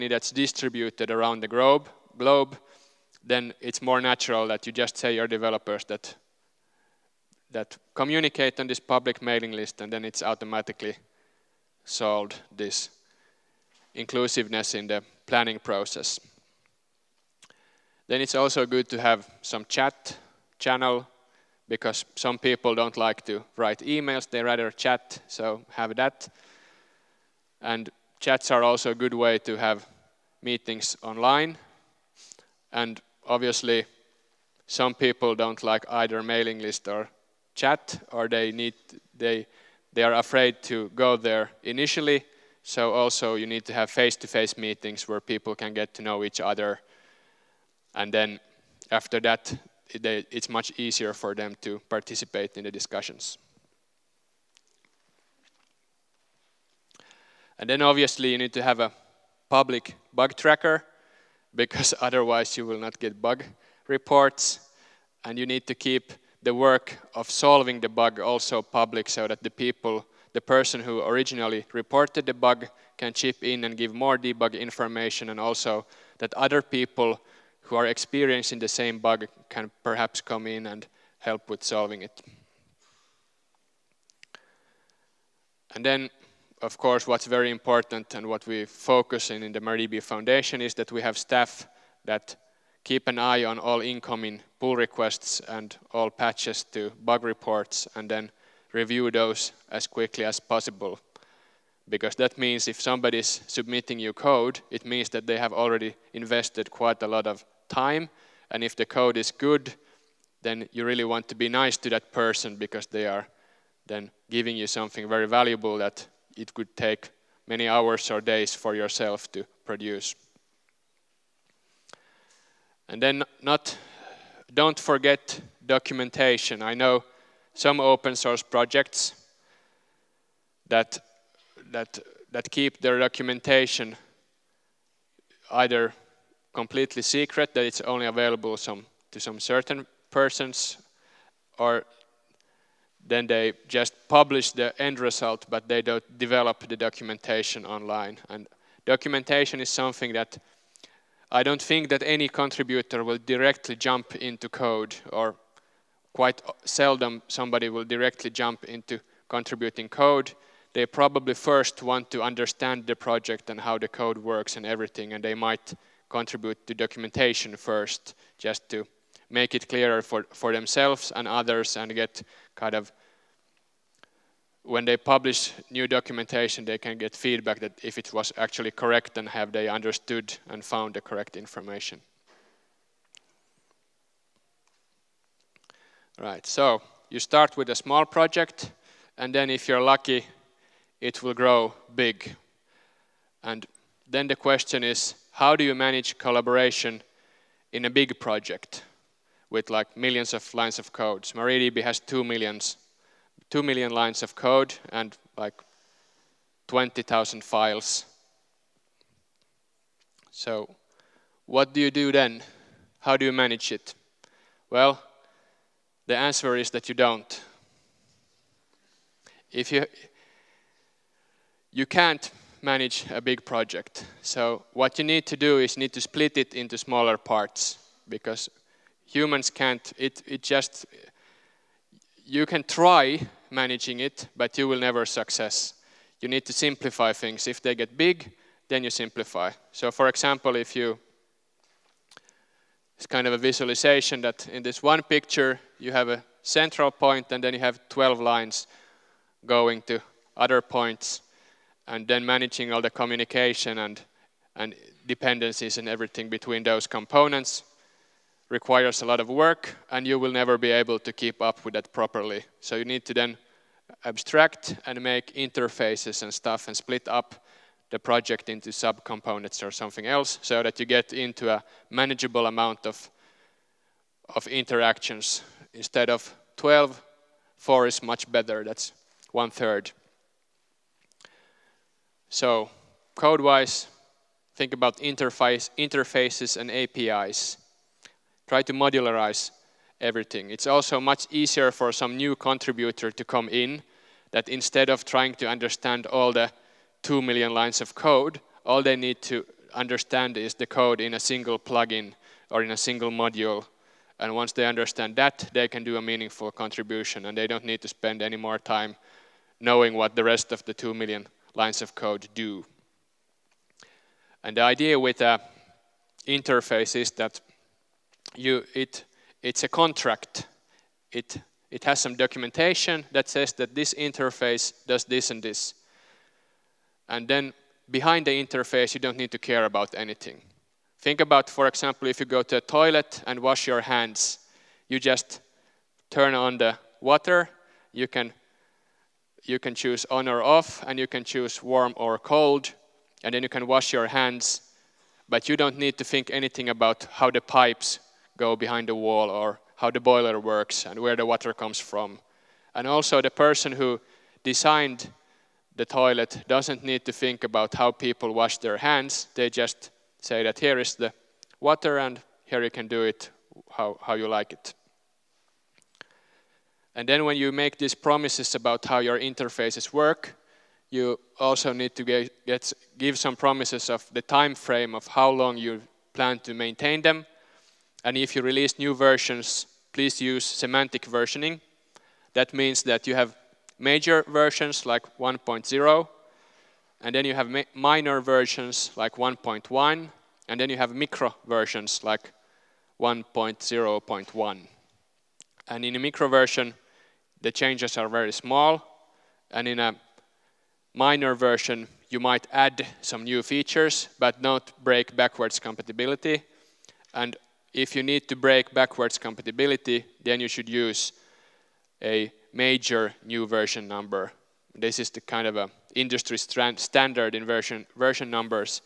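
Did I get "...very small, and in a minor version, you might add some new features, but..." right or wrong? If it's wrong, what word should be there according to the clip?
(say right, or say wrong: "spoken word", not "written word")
right.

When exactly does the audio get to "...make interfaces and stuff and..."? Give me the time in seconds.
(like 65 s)
265 s.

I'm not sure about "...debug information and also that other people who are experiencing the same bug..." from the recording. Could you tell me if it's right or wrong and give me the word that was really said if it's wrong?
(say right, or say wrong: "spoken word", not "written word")
right.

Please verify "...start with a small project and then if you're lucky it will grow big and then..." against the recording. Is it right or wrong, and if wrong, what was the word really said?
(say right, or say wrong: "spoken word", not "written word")
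right.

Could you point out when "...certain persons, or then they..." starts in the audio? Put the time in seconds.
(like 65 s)
139 s.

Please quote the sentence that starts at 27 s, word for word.
And chats are also a good way to have meetings online.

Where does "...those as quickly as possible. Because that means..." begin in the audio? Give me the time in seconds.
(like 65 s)
99 s.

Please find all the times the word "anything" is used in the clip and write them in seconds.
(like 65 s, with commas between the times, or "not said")
329 s, 346 s.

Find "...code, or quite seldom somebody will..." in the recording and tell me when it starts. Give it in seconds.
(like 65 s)
154 s.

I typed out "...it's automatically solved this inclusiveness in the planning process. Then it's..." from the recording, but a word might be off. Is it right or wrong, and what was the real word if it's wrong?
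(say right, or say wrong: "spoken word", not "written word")
right.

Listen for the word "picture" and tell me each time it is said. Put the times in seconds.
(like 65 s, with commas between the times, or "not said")
245 s.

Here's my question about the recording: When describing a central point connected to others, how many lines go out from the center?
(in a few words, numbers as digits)
12.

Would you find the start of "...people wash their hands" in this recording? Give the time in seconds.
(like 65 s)
357 s.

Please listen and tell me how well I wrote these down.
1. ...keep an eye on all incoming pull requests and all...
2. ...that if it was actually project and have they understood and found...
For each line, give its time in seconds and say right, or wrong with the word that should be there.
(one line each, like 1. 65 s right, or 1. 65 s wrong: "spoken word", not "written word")
1. 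92 s right
2. 177 s wrong: "correct", not "project".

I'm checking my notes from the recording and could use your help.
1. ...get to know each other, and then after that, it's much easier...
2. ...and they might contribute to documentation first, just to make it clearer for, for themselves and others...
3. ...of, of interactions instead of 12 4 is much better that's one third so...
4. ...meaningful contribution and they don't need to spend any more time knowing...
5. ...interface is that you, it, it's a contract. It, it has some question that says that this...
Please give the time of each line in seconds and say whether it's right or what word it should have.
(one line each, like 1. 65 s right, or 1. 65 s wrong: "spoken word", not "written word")
1. 45 s right
2. 165 s right
3. 272 s right
4. 306 s right
5. 316 s wrong: "documentation", not "question".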